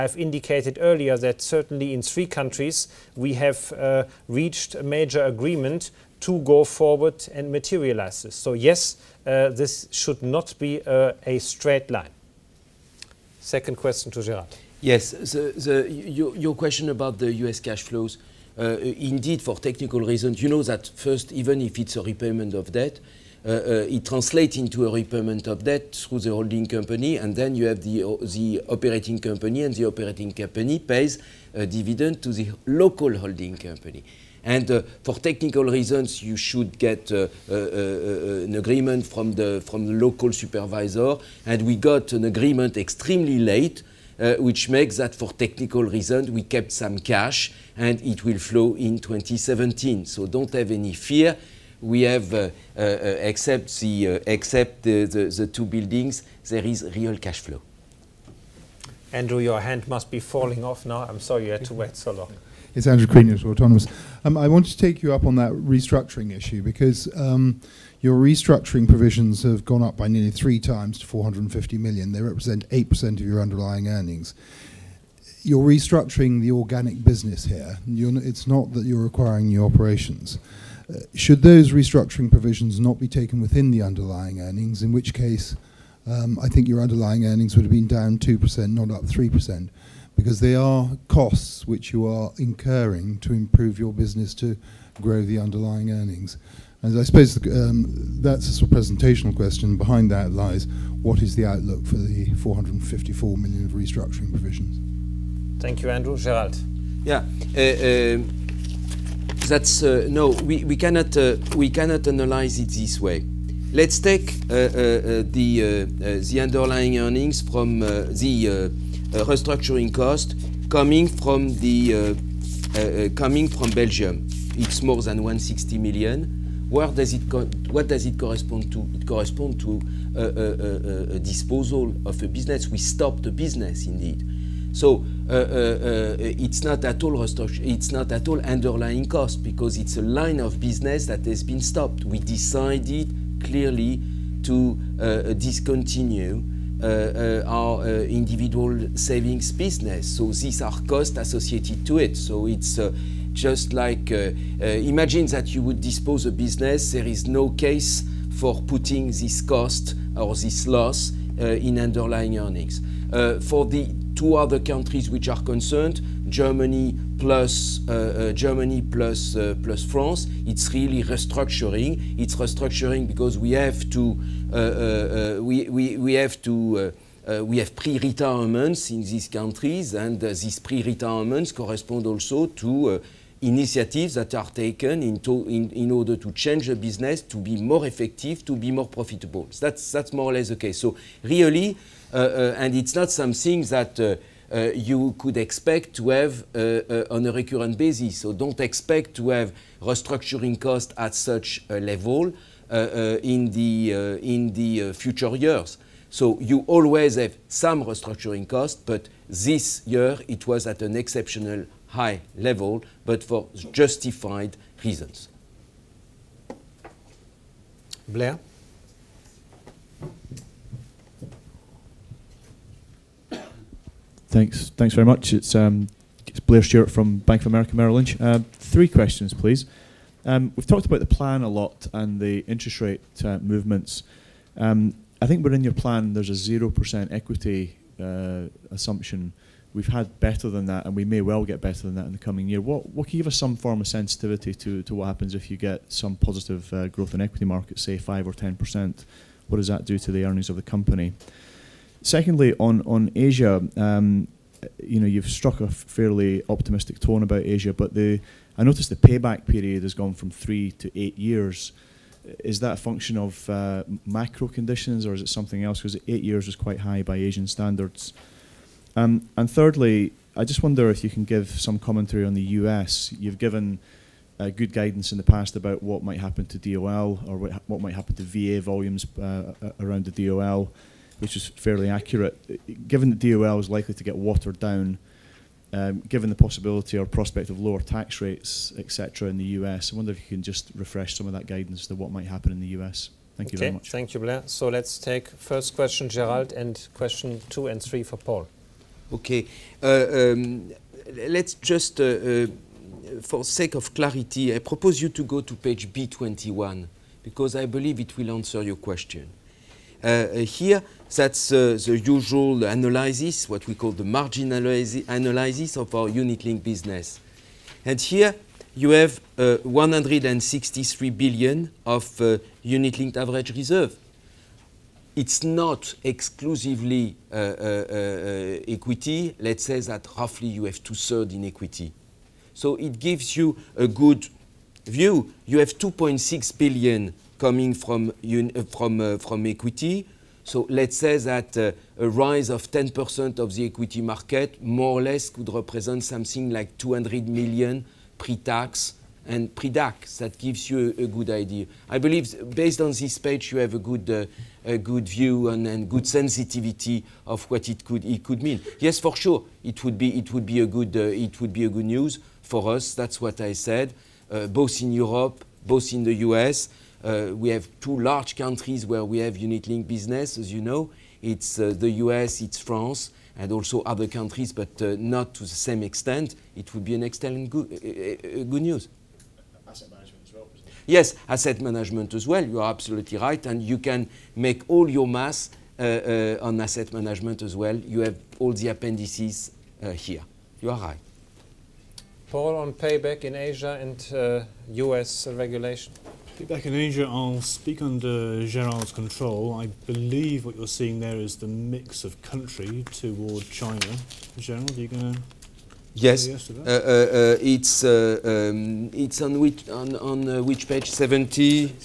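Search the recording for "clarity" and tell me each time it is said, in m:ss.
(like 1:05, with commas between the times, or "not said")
5:03.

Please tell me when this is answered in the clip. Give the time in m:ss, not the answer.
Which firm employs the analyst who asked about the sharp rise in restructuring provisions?
1:03.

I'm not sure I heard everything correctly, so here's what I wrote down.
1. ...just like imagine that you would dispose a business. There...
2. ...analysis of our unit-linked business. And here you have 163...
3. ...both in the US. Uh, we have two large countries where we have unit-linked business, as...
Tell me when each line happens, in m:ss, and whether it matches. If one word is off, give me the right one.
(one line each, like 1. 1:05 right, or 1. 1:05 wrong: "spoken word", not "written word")
1. 2:33 right
2. 5:14 right
3. 6:05 right.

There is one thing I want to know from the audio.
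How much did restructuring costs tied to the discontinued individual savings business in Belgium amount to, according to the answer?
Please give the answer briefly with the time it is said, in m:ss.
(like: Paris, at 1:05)
more than 160 million, at 2:04.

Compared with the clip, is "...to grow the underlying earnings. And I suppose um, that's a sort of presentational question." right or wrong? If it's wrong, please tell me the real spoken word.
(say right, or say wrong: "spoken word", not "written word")
right.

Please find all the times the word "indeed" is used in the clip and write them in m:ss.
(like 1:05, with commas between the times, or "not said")
0:18, 2:13.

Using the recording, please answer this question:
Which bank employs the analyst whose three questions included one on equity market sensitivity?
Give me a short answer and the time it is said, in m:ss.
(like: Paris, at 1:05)
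Bank of America Merrill Lynch, at 3:47.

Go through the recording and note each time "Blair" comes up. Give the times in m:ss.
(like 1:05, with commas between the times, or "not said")
3:38, 3:46, 4:54.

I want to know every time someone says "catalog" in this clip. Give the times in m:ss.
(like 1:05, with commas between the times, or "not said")
not said.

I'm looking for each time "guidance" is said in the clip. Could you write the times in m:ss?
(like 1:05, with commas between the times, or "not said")
4:34, 4:51.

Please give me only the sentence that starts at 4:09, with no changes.
What does that do to the earnings of the company?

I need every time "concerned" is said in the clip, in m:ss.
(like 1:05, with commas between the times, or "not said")
2:45.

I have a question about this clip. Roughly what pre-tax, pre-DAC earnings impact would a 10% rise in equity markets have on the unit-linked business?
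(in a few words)
200 million.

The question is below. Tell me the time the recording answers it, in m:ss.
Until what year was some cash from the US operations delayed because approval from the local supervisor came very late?
0:48.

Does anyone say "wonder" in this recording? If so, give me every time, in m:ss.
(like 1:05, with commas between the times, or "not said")
4:30, 4:49.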